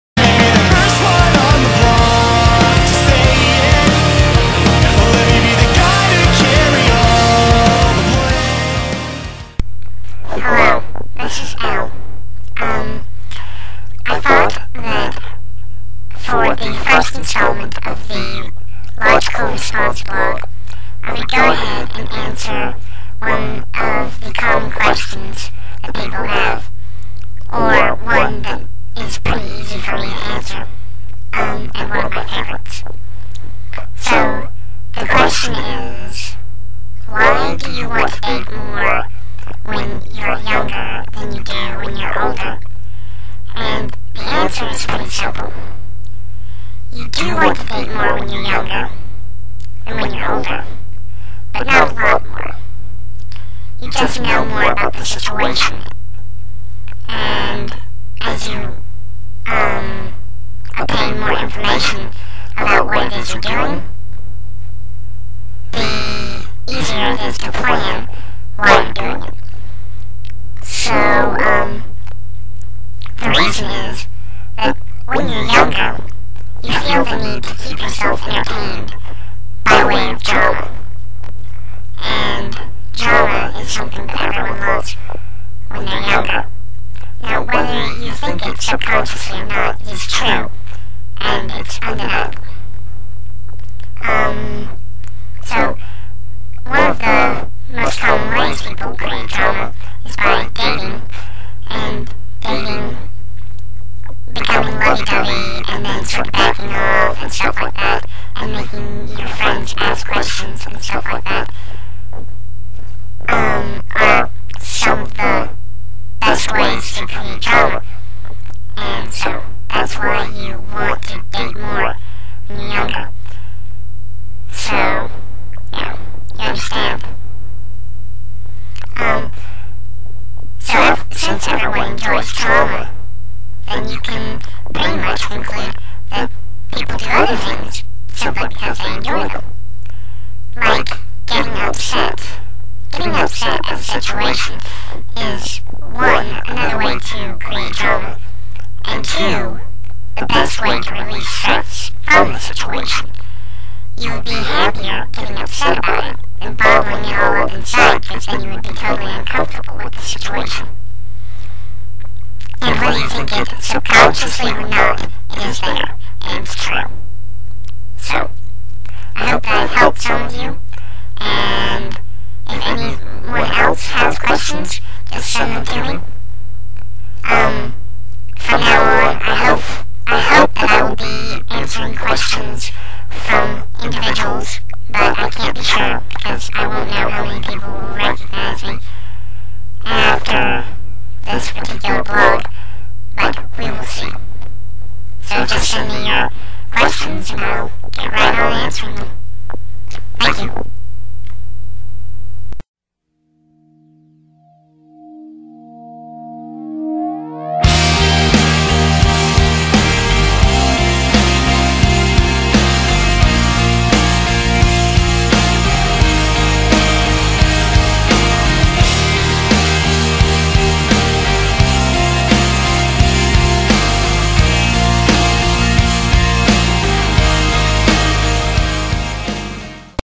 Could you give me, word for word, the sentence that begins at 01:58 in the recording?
And so that's why you want to date more younger.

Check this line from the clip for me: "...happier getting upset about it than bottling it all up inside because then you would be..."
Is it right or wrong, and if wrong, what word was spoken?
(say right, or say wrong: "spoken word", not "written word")
right.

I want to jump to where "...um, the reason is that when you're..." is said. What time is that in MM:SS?
01:10.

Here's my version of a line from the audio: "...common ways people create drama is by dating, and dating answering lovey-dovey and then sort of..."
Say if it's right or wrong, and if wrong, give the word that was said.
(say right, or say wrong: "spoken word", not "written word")
wrong: "becoming", not "answering".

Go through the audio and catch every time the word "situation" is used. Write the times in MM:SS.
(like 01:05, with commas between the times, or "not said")
00:55, 02:23, 02:32, 02:40.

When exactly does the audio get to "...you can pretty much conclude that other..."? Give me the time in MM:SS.
02:13.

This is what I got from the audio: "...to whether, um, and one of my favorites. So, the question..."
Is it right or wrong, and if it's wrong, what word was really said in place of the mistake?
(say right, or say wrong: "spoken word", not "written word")
wrong: "answer", not "whether".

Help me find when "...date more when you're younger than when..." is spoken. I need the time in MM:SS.
00:47.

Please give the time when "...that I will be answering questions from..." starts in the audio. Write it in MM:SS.
03:00.